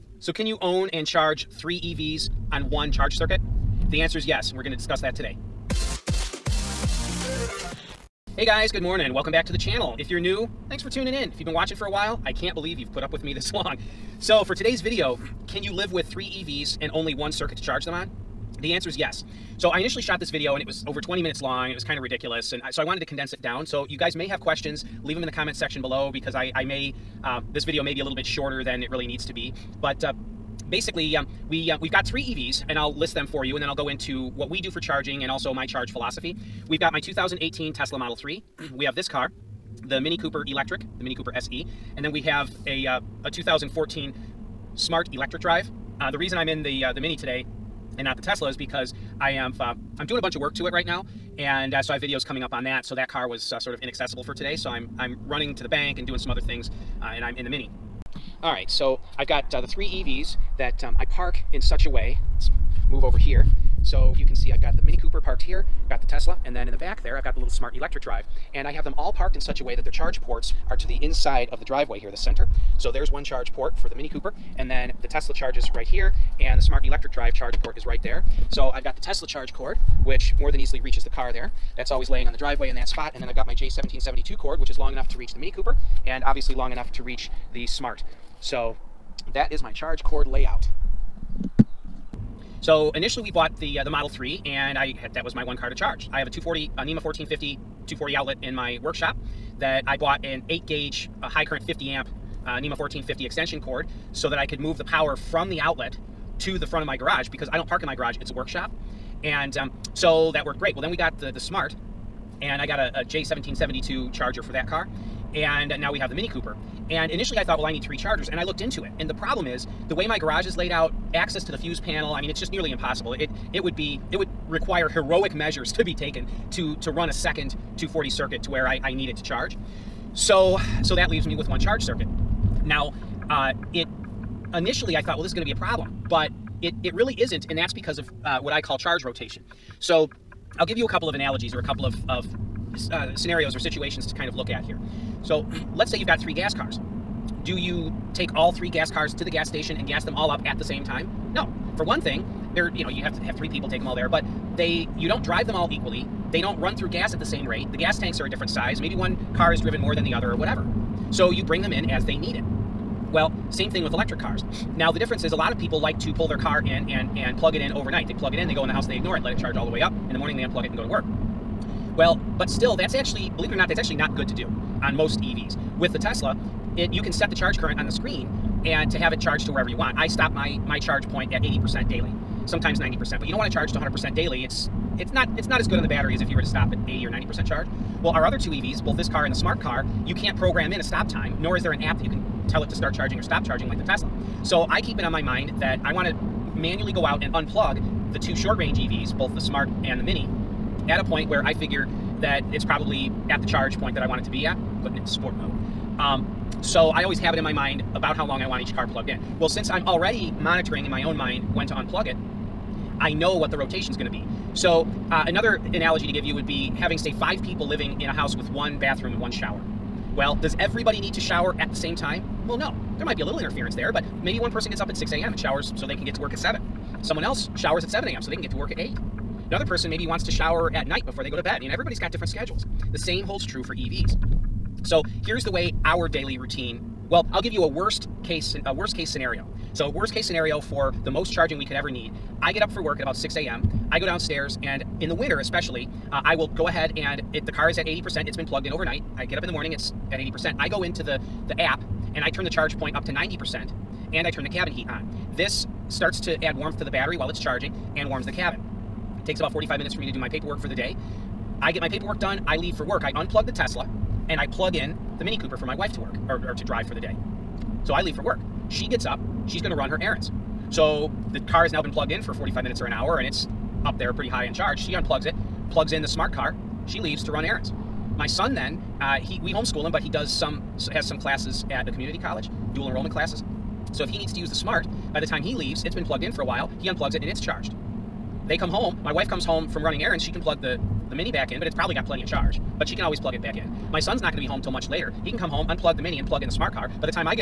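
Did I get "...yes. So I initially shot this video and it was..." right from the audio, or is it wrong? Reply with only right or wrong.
right.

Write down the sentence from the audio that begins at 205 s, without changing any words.
Um, so I always have it in my mind about how long I want each car plugged in.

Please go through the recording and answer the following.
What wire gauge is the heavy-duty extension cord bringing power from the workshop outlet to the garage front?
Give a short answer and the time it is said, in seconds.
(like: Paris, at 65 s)
8 gauge, at 100 s.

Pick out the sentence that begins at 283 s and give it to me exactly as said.
So if he needs to use the smart, by the time he leaves, it's been plugged in for a while.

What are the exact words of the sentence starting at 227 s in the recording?
Someone else showers at 7 a.m.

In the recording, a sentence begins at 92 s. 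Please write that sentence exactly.
So initially we bought the uh, the Model 3 and I had, that was my one car to charge.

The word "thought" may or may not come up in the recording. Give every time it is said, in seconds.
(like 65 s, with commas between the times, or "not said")
117 s, 135 s.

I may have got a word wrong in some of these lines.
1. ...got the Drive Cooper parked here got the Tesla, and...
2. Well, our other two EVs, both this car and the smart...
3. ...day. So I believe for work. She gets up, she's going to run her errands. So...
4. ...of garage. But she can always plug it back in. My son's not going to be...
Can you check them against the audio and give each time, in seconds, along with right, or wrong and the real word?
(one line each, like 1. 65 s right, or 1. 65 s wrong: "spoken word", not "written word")
1. 64 s wrong: "Mini", not "Drive"
2. 188 s right
3. 266 s wrong: "leave", not "believe"
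4. 292 s wrong: "charge", not "garage".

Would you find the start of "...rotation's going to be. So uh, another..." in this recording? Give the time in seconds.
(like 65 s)
213 s.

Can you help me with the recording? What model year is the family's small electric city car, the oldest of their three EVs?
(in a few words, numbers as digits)
2014.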